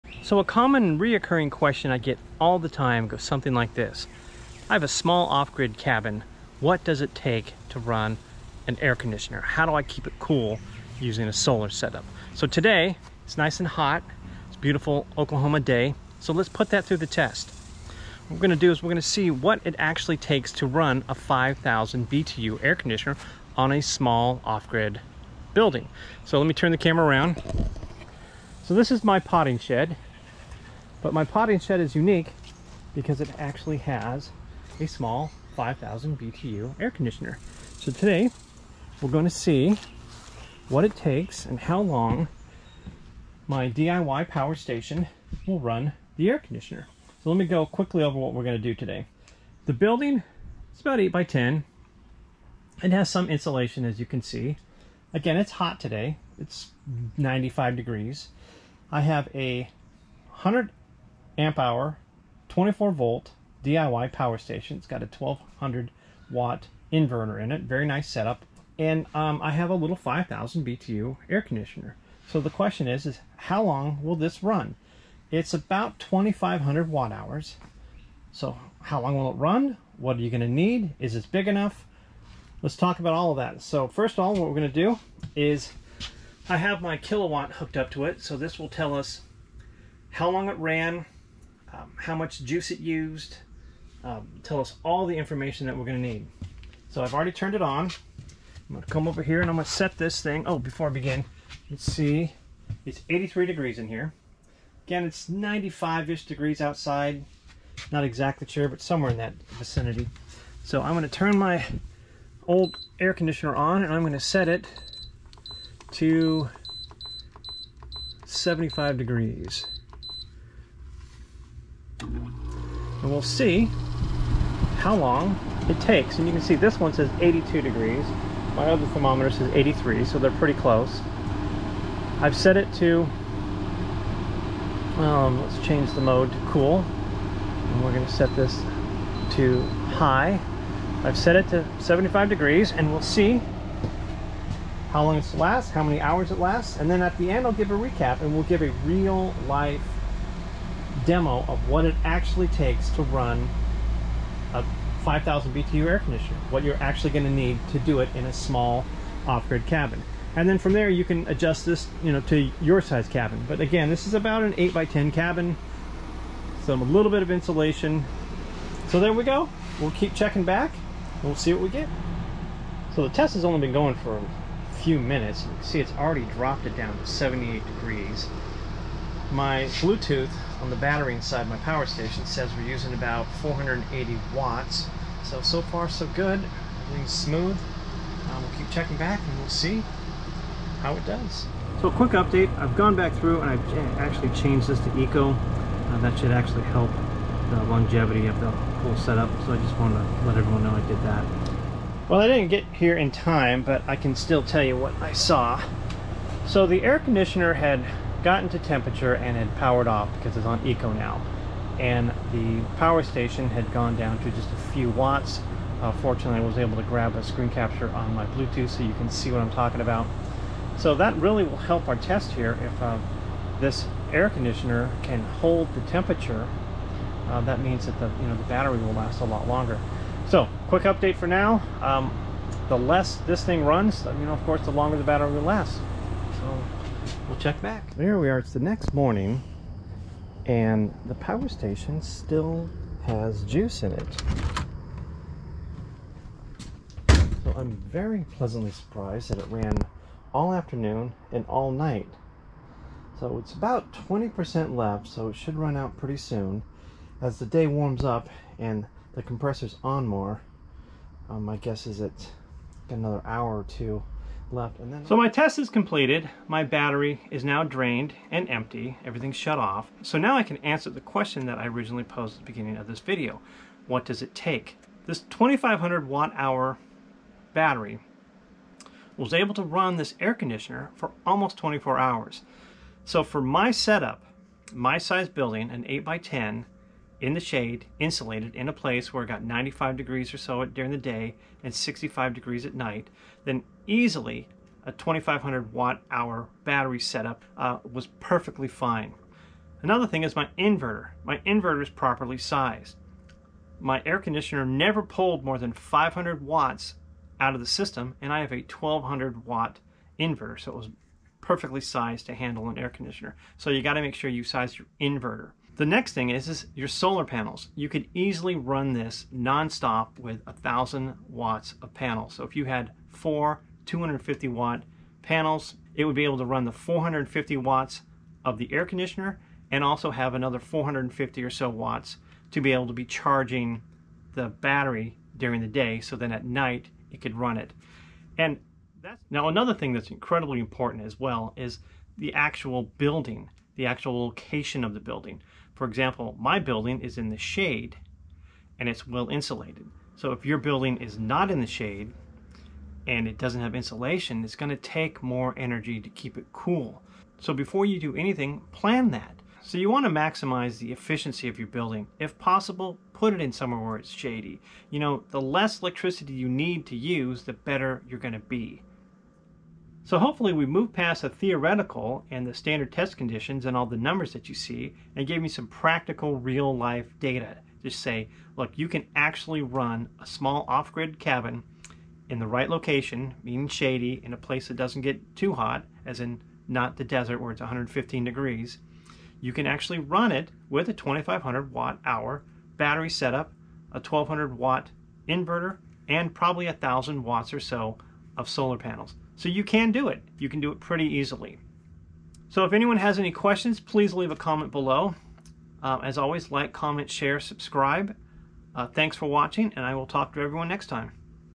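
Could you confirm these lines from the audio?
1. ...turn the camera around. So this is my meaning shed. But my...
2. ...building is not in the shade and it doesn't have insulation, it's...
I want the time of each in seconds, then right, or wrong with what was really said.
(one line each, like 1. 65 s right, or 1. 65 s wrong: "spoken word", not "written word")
1. 26 s wrong: "potting", not "meaning"
2. 350 s right.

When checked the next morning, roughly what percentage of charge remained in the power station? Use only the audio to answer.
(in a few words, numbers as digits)
20%.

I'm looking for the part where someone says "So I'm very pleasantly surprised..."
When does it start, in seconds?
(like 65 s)
247 s.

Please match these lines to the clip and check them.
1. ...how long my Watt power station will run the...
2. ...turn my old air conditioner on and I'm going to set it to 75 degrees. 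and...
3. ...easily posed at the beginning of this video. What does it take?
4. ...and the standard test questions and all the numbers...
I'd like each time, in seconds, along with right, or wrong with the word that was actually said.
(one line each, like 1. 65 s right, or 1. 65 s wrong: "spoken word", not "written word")
1. 41 s wrong: "DIY", not "Watt"
2. 111 s right
3. 271 s wrong: "originally", not "easily"
4. 372 s wrong: "conditions", not "questions".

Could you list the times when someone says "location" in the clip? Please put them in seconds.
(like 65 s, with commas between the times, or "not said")
344 s, 382 s.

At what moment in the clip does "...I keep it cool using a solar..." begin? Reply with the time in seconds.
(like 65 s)
9 s.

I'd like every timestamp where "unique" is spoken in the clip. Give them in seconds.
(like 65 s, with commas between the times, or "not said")
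31 s.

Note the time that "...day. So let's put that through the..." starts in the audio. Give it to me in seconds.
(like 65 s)
15 s.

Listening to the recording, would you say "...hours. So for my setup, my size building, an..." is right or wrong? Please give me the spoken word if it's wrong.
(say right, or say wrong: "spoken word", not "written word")
right.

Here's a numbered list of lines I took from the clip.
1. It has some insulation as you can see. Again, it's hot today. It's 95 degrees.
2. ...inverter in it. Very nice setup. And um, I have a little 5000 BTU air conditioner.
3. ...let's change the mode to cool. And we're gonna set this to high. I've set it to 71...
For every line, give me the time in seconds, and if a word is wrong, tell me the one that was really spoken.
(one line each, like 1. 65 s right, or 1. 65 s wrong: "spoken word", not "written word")
1. 52 s right
2. 66 s right
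3. 135 s wrong: "75", not "71".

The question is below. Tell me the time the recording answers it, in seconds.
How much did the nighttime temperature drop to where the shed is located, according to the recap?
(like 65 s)
291 s.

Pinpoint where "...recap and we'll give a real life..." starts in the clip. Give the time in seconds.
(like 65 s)
147 s.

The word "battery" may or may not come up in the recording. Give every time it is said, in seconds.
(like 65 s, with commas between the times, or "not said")
180 s, 228 s, 235 s, 266 s, 277 s, 296 s, 334 s, 392 s.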